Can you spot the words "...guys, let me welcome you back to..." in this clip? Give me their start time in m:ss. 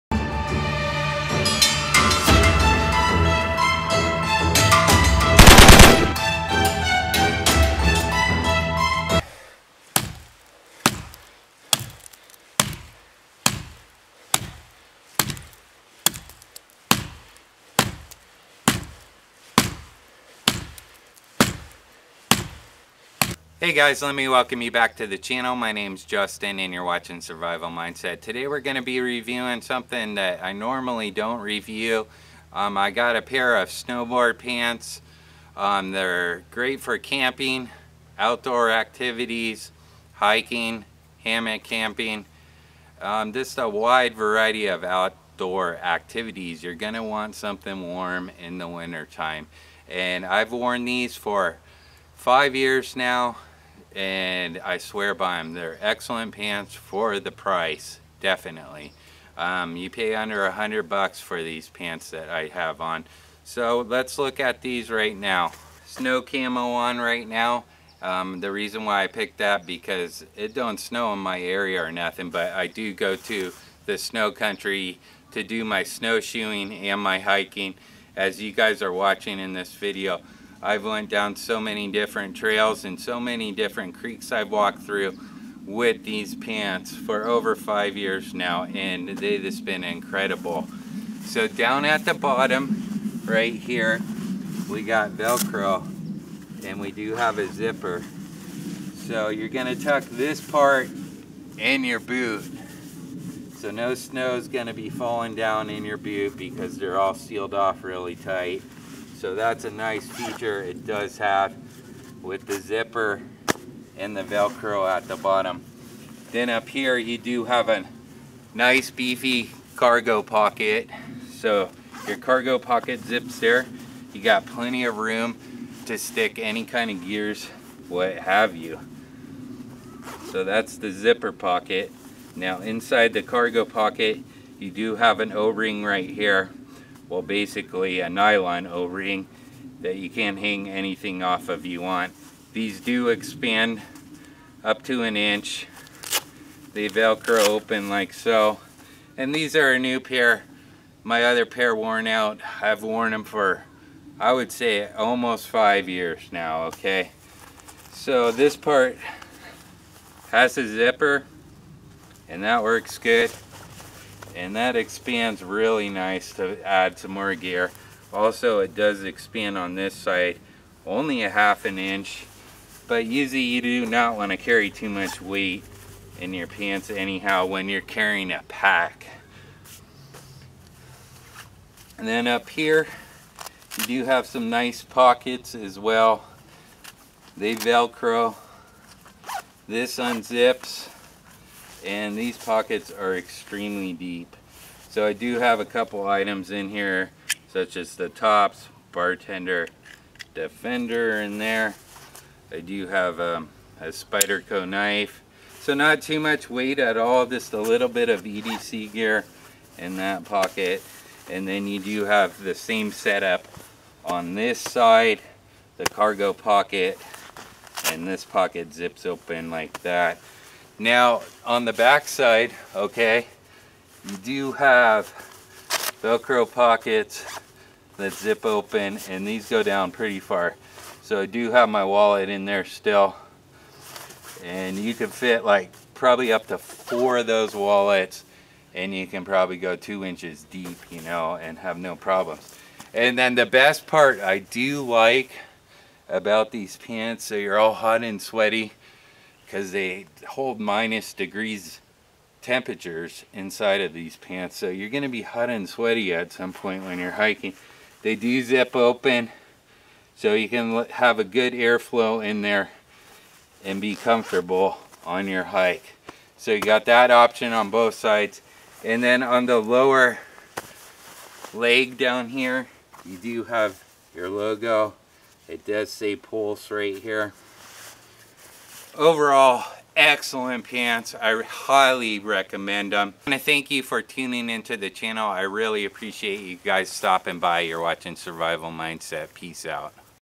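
0:23.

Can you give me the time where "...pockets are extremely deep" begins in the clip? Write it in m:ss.
3:12.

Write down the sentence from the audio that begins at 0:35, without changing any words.
Um, they're great for camping, outdoor activities, hiking, hammock camping.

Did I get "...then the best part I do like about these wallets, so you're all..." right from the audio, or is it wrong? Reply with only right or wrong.
wrong.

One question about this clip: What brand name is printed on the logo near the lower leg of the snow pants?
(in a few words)
Pulse.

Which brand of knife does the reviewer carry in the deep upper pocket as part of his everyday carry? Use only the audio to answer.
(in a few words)
Spyderco.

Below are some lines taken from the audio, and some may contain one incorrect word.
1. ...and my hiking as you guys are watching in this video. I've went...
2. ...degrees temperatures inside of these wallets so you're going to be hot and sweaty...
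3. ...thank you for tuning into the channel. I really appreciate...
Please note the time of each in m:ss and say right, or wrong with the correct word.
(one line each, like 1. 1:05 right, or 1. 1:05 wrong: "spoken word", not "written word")
1. 1:16 right
2. 4:11 wrong: "pants", not "wallets"
3. 4:43 right.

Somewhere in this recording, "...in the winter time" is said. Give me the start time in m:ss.
0:48.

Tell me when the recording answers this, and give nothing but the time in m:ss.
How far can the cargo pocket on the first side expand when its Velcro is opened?
2:24.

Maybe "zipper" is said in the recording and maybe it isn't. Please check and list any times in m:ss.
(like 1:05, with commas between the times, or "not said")
1:37, 1:52, 2:10, 2:40.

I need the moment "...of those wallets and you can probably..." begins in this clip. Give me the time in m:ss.
3:57.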